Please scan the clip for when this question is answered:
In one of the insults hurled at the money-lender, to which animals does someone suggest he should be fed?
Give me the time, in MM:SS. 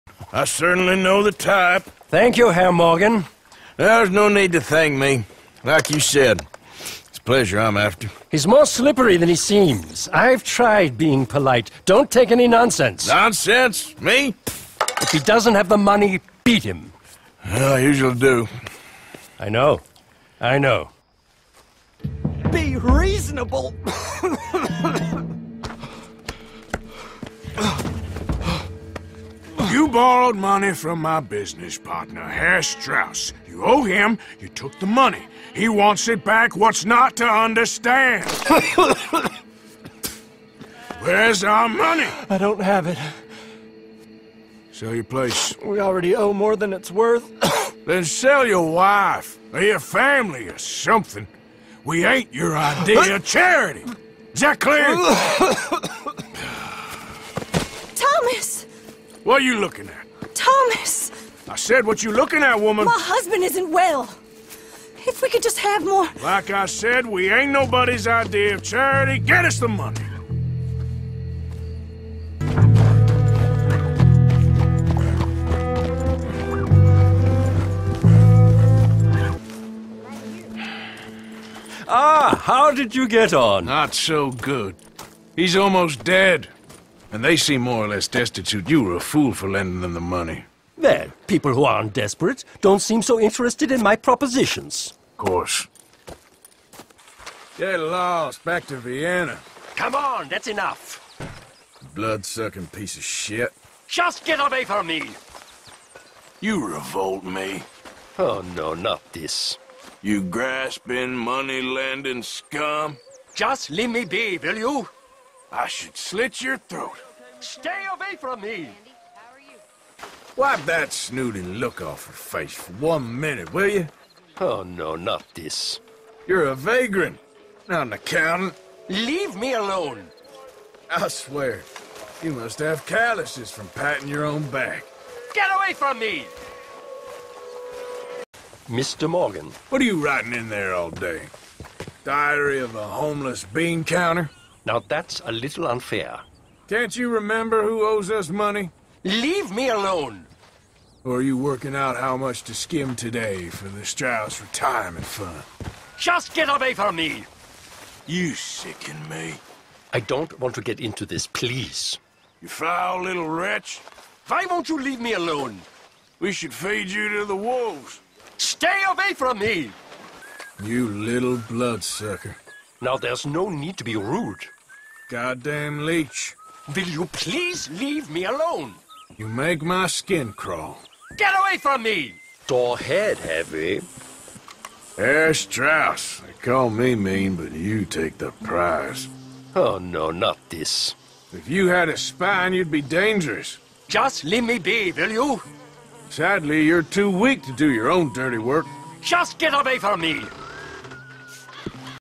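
02:47.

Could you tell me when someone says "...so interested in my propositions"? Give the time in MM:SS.
01:33.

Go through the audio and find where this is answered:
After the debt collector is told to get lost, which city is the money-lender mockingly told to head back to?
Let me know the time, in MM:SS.
01:38.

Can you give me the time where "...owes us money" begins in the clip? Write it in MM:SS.
02:27.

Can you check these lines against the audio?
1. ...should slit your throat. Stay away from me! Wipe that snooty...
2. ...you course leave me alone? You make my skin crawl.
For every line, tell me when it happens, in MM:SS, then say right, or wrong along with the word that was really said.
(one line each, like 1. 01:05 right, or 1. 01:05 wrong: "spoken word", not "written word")
1. 01:55 right
2. 02:56 wrong: "please", not "course".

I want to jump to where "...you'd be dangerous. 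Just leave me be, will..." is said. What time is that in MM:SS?
03:12.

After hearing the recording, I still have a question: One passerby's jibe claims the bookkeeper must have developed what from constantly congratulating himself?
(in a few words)
calluses.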